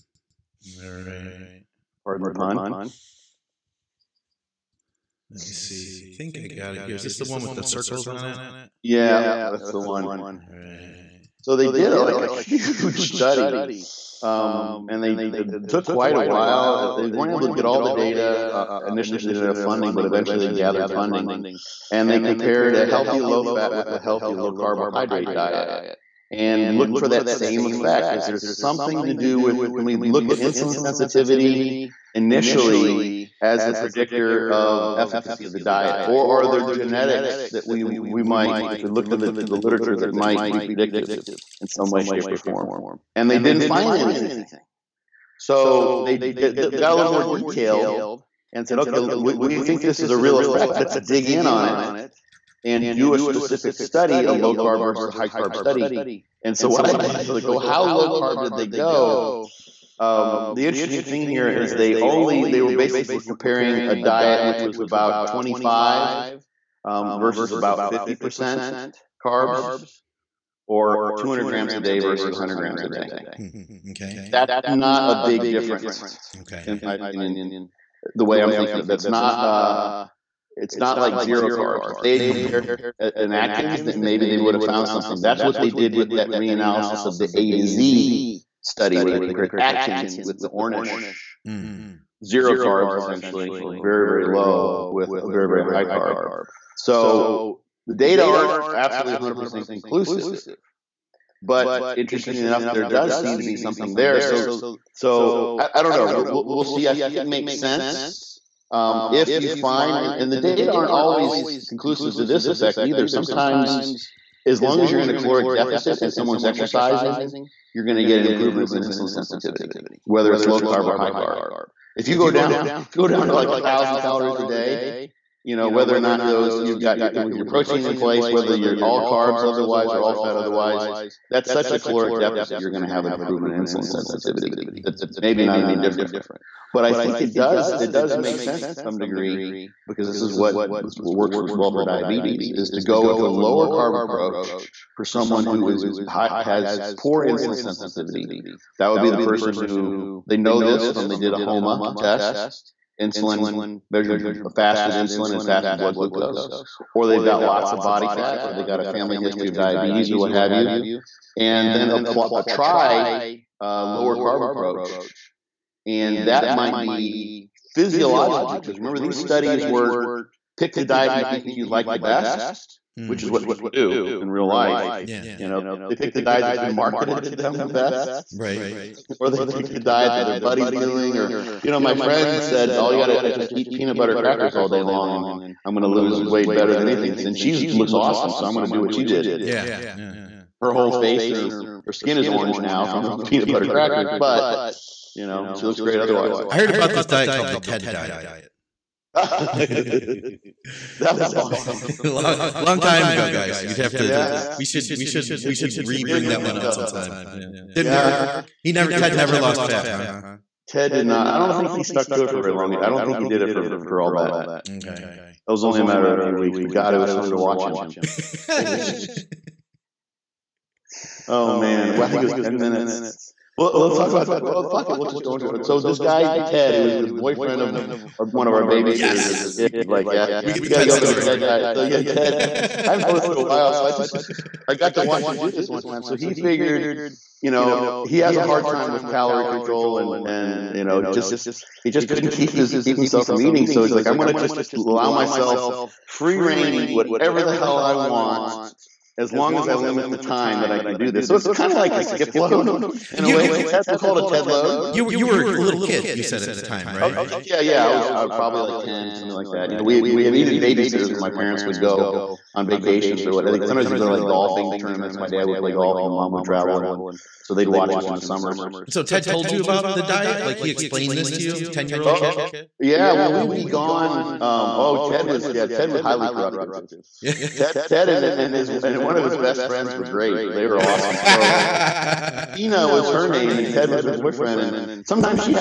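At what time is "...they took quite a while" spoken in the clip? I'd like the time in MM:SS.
00:15.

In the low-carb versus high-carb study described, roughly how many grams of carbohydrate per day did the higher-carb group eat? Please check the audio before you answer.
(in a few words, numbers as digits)
200 grams.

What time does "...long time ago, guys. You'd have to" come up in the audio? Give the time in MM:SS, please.
03:22.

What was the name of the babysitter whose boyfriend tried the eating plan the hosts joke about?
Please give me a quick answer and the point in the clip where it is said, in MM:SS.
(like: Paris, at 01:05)
Tina, at 04:42.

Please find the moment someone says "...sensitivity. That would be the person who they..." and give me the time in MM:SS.
02:27.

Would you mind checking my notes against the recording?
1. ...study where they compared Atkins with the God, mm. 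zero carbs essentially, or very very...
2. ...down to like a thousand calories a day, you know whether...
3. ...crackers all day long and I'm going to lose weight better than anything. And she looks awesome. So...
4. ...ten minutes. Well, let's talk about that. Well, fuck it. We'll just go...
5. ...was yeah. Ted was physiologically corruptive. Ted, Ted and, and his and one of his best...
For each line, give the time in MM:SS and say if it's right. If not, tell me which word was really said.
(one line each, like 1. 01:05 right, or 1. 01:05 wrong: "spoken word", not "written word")
1. 01:28 wrong: "Ornish", not "God"
2. 02:03 right
3. 03:04 right
4. 03:42 right
5. 04:35 wrong: "highly", not "physiologically".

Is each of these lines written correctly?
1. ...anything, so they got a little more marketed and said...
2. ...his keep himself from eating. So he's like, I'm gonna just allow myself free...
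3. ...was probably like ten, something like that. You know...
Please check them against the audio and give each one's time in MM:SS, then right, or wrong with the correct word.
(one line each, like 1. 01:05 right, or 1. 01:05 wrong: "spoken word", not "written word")
1. 00:43 wrong: "detailed", not "marketed"
2. 04:02 right
3. 04:18 right.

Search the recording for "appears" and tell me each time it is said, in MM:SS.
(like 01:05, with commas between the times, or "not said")
not said.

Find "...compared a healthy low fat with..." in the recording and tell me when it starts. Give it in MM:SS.
00:22.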